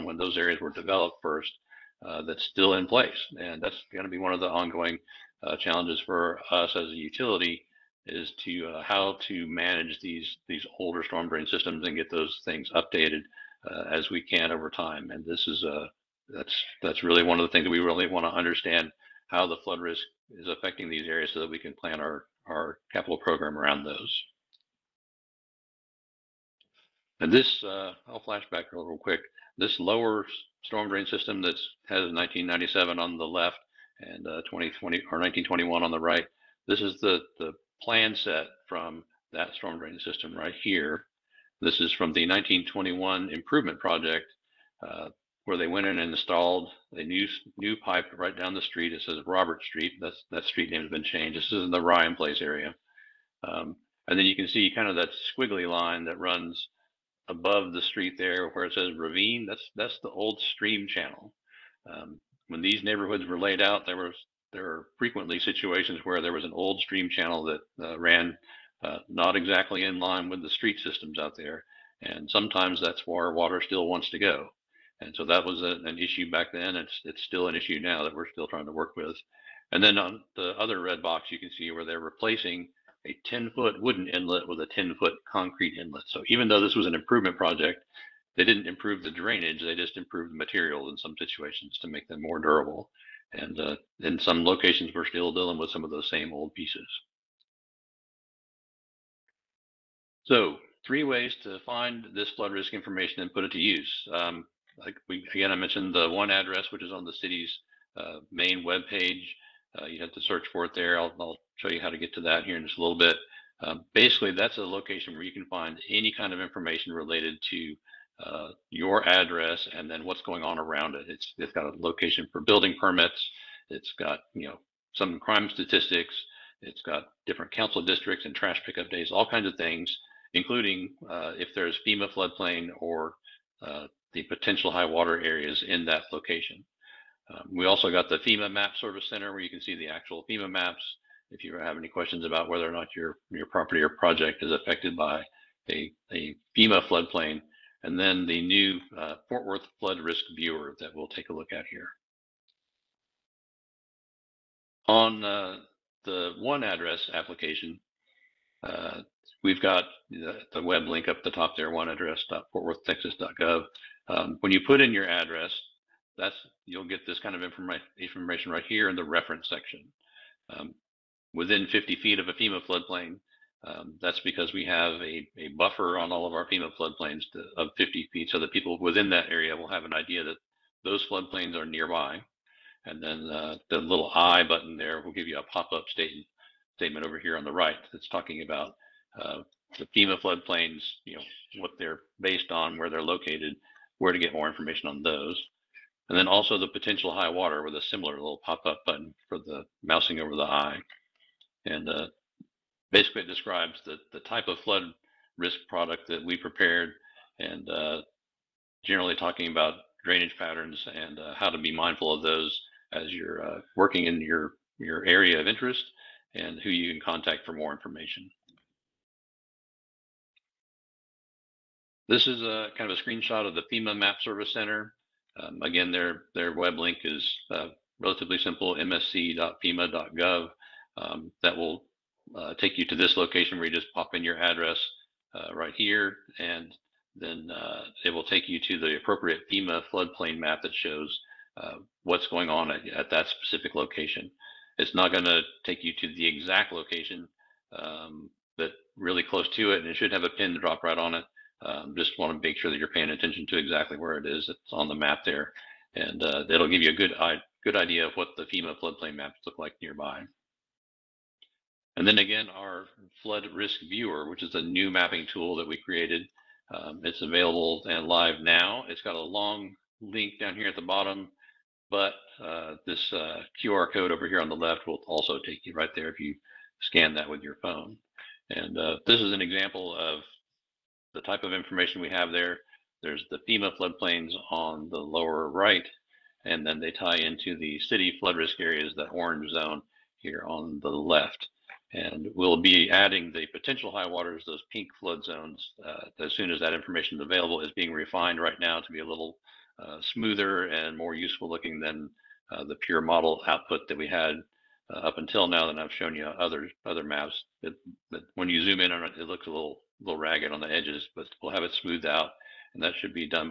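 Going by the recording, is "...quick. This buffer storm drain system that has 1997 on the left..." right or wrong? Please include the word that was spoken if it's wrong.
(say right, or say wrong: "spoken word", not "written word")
wrong: "lower", not "buffer".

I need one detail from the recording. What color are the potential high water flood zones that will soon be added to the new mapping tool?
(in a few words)
pink.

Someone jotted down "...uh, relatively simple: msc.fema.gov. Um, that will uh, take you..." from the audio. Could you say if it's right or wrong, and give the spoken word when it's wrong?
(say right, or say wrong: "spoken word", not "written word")
right.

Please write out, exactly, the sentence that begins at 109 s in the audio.
Uh, you have to search for it there.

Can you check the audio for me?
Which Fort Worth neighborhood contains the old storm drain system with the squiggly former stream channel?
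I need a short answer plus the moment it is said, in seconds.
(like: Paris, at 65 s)
Ryan Place, at 51 s.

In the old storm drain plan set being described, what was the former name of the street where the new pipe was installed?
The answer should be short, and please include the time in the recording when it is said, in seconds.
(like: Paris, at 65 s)
Robert Street, at 49 s.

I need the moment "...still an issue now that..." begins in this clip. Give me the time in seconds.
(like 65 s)
77 s.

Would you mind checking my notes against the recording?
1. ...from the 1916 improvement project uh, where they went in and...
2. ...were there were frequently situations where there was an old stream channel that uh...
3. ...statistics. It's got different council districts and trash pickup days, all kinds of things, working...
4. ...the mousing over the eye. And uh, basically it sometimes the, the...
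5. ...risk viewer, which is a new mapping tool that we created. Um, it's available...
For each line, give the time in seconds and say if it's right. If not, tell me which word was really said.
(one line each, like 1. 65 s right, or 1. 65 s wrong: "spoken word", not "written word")
1. 41 s wrong: "1921", not "1916"
2. 63 s right
3. 125 s wrong: "including", not "working"
4. 199 s wrong: "describes", not "sometimes"
5. 263 s right.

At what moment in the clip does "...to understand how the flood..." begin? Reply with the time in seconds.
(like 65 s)
18 s.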